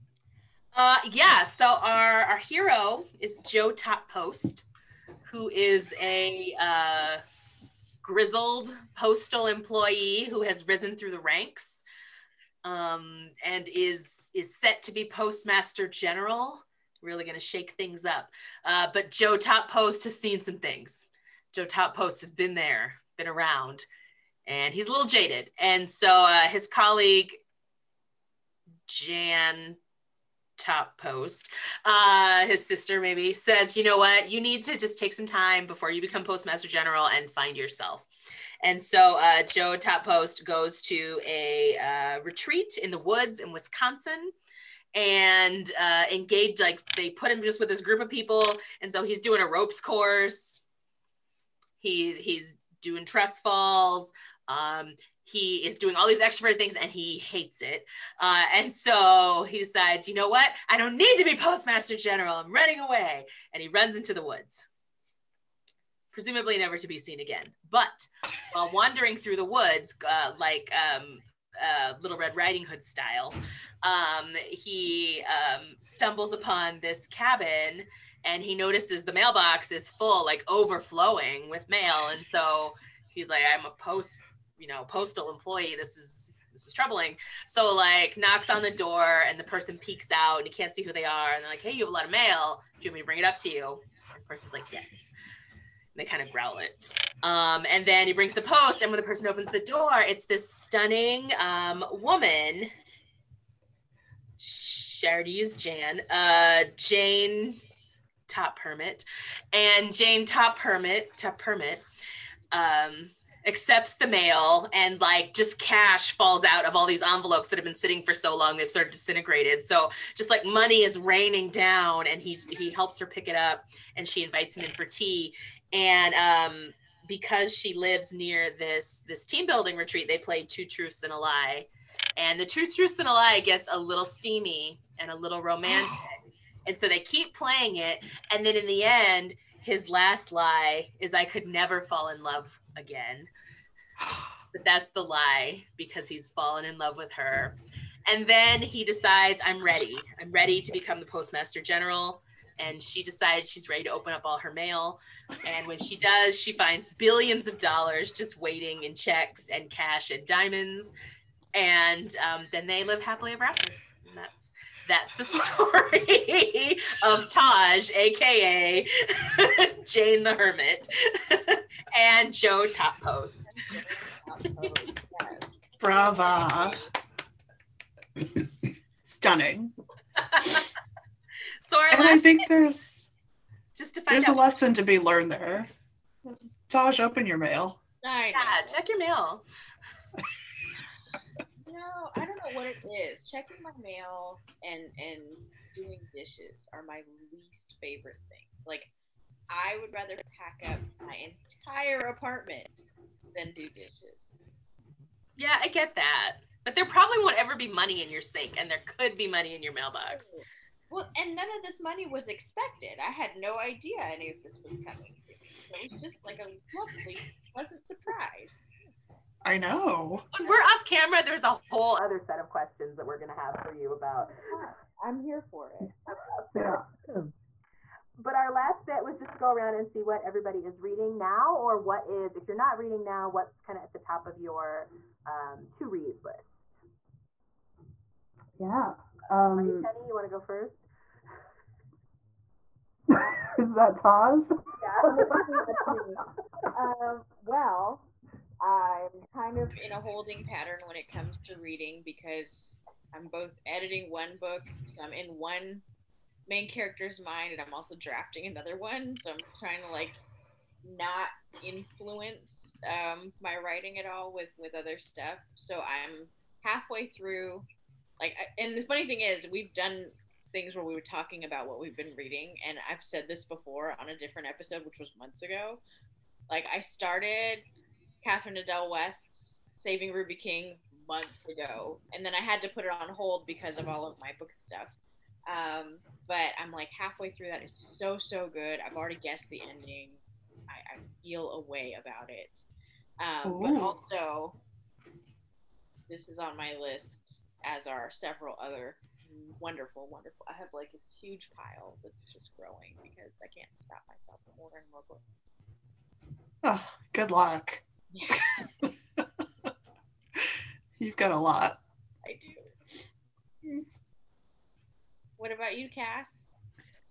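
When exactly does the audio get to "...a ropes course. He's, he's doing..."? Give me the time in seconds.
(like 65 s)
49 s.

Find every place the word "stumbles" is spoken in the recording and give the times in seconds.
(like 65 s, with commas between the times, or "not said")
75 s.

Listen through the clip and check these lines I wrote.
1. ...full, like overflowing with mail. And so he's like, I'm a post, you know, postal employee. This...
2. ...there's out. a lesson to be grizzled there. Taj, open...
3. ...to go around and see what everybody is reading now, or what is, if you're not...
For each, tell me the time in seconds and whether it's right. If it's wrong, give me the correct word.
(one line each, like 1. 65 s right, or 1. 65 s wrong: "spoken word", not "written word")
1. 79 s right
2. 184 s wrong: "learned", not "grizzled"
3. 229 s right.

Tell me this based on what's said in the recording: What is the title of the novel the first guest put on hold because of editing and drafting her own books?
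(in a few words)
Saving Ruby King.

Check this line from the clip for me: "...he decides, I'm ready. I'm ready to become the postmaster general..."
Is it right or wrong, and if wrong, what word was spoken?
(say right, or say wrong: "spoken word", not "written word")
right.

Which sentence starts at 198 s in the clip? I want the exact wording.
Like I would rather pack up my entire apartment than do dishes.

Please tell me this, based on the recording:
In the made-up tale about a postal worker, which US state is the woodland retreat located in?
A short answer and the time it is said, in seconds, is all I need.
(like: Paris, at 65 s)
Wisconsin, at 43 s.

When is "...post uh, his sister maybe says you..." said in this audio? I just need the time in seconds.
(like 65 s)
30 s.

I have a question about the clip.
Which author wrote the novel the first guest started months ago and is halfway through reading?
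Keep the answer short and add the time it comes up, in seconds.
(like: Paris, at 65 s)
Catherine Adel West, at 278 s.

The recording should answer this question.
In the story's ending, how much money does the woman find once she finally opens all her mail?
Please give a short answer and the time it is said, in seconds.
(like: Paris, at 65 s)
Billions of dollars, at 156 s.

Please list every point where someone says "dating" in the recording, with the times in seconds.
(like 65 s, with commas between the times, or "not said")
not said.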